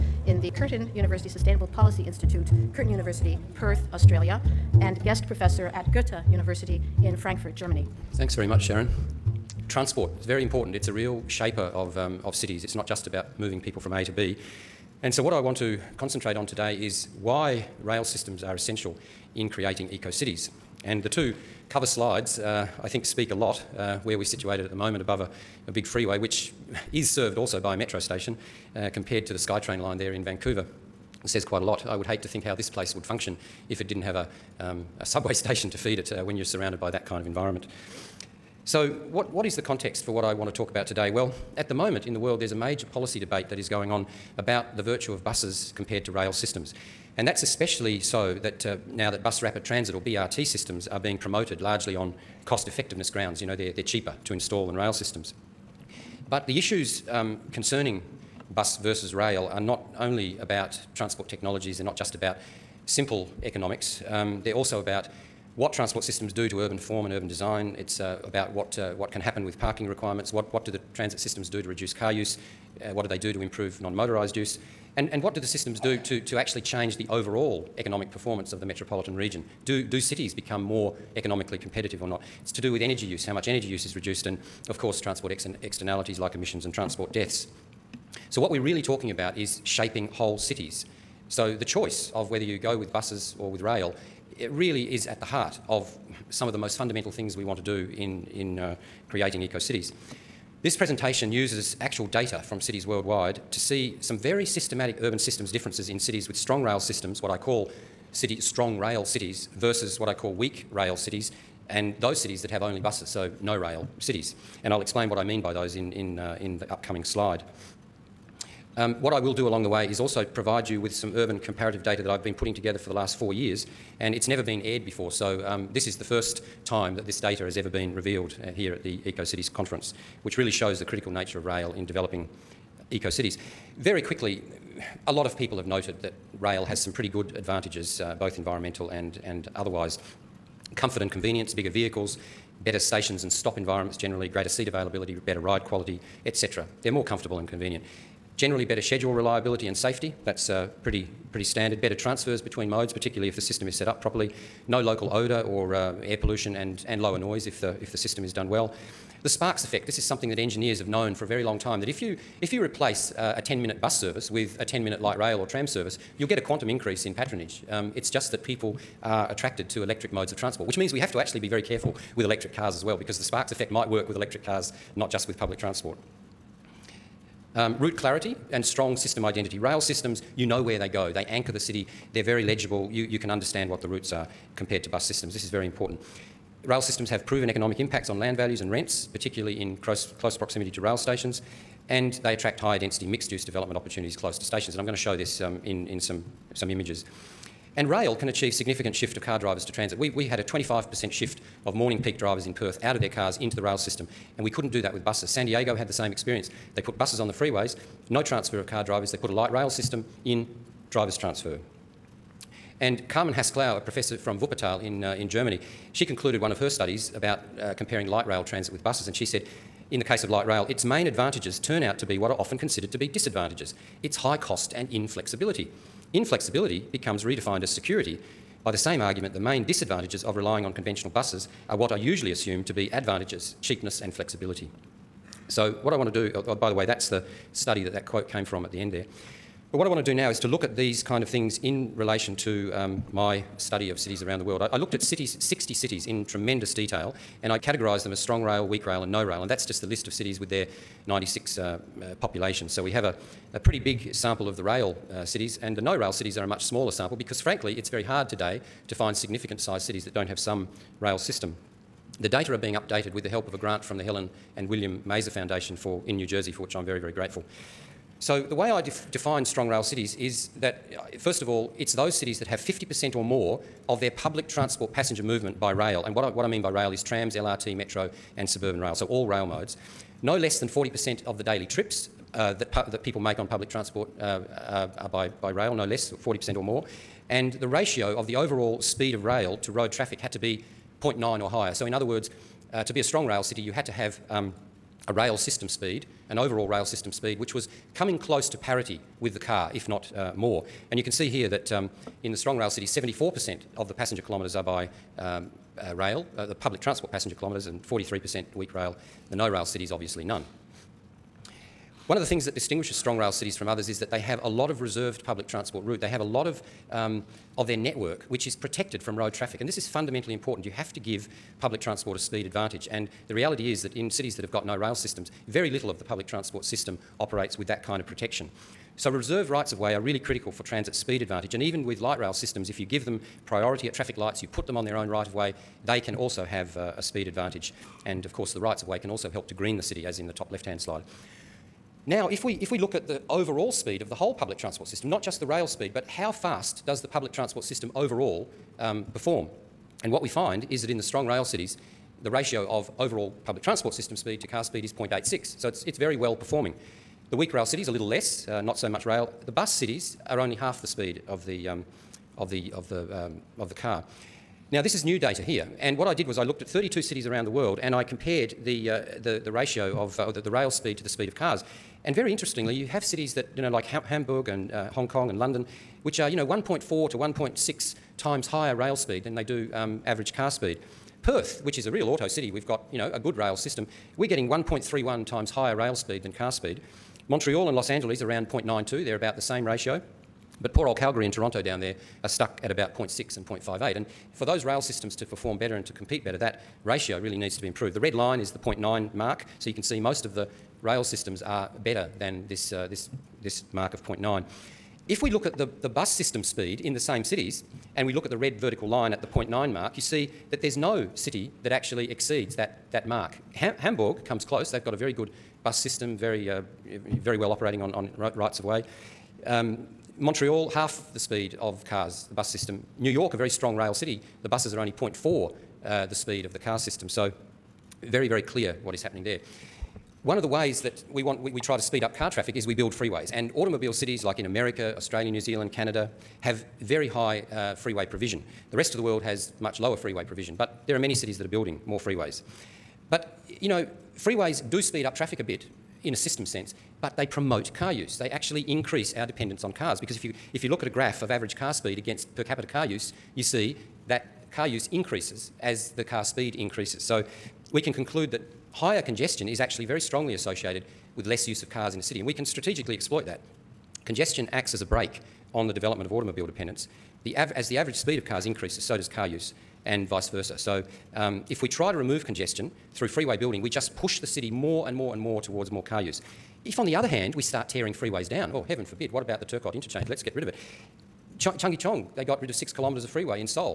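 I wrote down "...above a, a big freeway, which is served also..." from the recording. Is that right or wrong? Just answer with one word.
right.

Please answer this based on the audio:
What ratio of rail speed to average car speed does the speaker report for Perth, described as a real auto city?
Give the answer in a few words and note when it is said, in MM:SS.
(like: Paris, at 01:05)
1.31, at 06:24.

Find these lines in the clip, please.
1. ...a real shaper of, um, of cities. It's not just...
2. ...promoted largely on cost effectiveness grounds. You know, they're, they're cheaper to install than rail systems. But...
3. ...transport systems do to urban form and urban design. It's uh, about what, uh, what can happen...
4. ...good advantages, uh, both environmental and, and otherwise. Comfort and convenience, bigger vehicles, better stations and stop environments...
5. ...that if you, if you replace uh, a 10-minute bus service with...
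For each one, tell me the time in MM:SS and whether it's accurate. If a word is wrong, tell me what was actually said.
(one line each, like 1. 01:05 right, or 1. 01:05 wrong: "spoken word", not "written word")
1. 00:10 right
2. 00:51 right
3. 01:05 right
4. 02:17 right
5. 02:41 right.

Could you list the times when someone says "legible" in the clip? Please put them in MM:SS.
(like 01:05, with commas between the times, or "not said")
03:02.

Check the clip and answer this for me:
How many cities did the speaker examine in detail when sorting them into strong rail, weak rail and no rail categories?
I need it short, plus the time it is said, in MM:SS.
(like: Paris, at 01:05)
60, at 04:05.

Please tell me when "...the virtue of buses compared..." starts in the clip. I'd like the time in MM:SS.
00:44.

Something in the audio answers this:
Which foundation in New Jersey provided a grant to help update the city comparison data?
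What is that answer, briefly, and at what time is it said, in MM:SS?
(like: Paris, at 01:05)
Helen and William Mazer Foundation, at 04:24.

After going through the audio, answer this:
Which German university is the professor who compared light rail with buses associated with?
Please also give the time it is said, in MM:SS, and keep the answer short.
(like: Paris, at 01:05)
Wuppertal, at 03:34.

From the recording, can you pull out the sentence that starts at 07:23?
But, you know, freeways do speed up traffic a bit in a system sense, but they promote car use.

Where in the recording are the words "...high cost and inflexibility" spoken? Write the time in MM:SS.
03:44.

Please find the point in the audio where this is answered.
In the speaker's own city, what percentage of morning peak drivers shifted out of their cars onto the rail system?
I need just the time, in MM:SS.
03:20.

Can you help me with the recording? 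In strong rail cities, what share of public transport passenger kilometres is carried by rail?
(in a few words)
74%.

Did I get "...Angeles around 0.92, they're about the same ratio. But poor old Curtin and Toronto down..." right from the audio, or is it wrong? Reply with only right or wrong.
wrong.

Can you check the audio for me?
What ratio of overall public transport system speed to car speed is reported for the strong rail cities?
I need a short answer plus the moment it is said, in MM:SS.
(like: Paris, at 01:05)
0.86, at 05:54.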